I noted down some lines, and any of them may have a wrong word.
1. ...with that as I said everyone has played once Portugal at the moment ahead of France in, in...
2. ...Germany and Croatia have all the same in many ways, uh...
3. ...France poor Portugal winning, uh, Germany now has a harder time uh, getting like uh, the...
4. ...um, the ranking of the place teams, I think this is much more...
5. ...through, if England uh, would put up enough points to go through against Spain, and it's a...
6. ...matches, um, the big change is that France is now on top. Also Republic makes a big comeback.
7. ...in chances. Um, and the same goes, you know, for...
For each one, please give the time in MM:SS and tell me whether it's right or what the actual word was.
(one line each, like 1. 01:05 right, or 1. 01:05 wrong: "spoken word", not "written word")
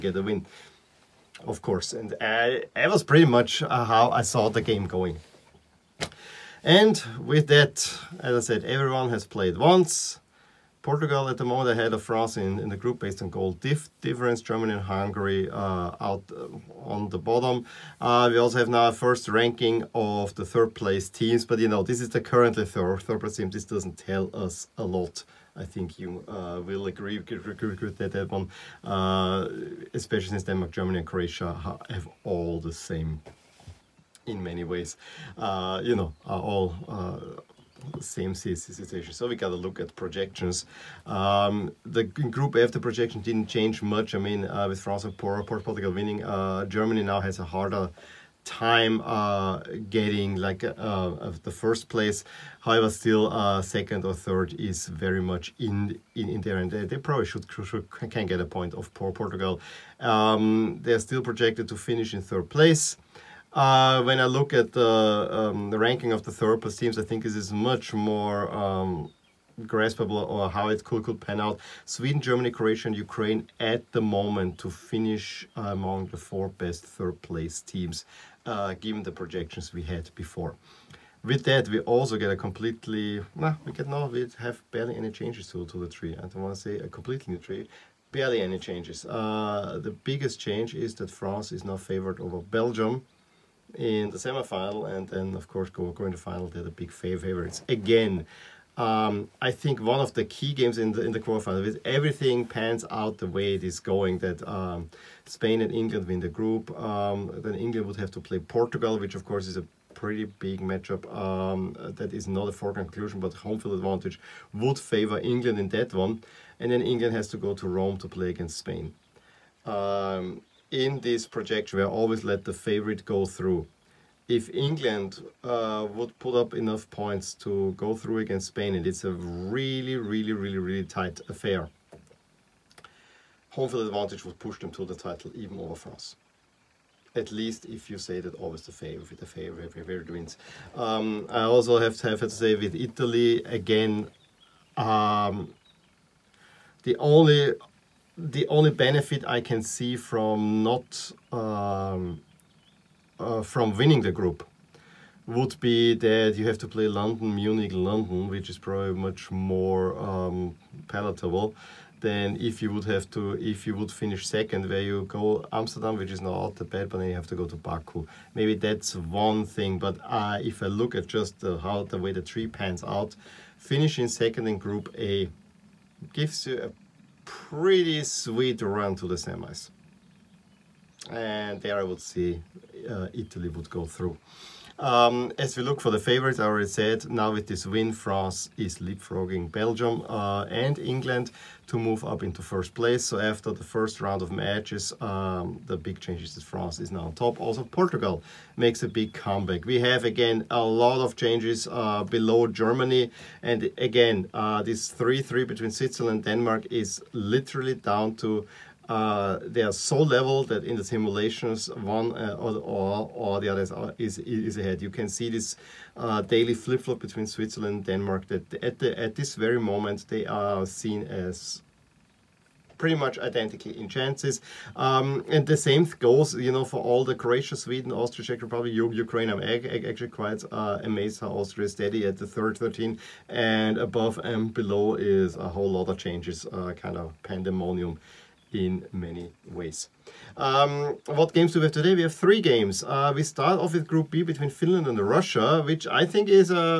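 1. 00:07 right
2. 00:30 right
3. 00:44 right
4. 01:05 right
5. 02:03 right
6. 03:14 wrong: "Portugal", not "Republic"
7. 03:43 right.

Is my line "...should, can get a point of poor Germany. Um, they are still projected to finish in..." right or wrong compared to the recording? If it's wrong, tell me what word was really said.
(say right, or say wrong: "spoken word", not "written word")
wrong: "Portugal", not "Germany".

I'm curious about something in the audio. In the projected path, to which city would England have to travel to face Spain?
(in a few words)
Rome.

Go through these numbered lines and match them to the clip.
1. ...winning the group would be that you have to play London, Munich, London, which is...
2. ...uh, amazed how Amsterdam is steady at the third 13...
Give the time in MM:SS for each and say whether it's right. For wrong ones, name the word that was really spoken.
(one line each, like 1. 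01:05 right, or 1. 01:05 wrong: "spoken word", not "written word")
1. 02:33 right
2. 03:50 wrong: "Austria", not "Amsterdam".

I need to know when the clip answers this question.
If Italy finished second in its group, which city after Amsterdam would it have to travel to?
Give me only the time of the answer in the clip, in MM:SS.
02:47.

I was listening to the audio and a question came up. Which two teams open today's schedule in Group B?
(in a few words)
Finland and Russia.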